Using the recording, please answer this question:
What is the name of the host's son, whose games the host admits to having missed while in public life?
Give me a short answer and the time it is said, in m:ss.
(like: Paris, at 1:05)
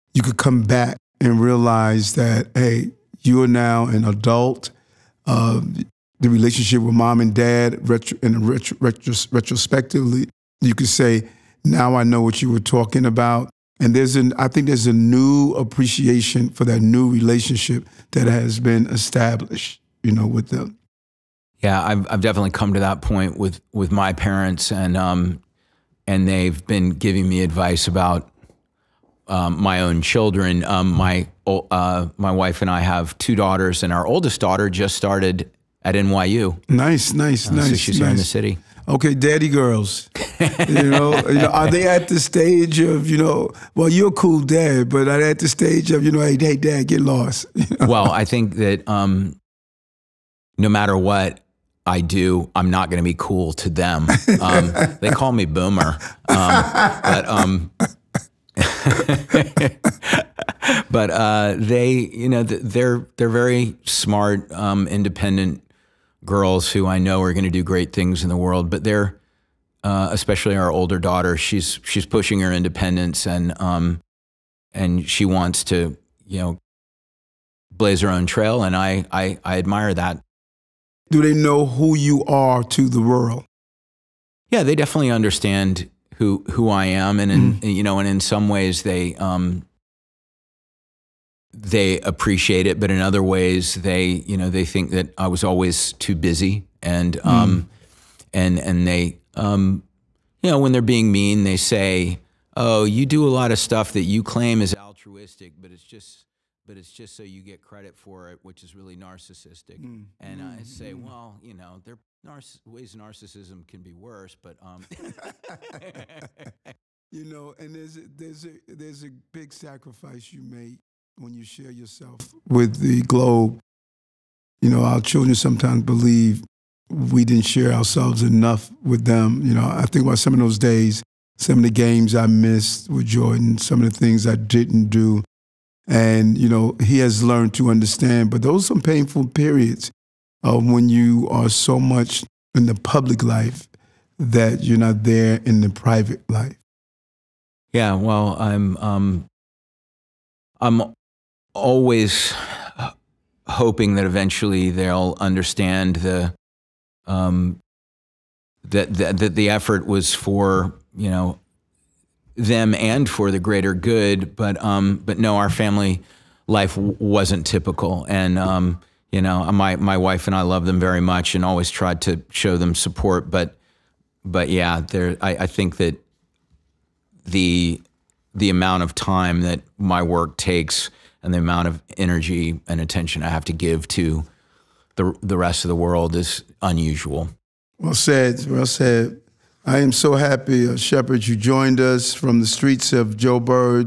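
Jordan, at 2:13.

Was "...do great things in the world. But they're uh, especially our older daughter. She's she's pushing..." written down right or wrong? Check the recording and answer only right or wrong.
right.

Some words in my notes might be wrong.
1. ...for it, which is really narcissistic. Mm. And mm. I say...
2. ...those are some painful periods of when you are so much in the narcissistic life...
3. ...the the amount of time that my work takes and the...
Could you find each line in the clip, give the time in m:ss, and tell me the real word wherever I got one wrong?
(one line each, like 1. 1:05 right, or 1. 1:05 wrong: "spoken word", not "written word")
1. 1:47 right
2. 2:18 wrong: "public", not "narcissistic"
3. 2:57 right.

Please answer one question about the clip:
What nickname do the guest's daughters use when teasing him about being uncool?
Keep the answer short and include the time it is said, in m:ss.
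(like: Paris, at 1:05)
boomer, at 0:55.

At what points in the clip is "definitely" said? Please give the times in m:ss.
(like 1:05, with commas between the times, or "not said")
0:22, 1:24.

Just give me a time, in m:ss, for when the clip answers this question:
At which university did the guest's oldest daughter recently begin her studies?
0:35.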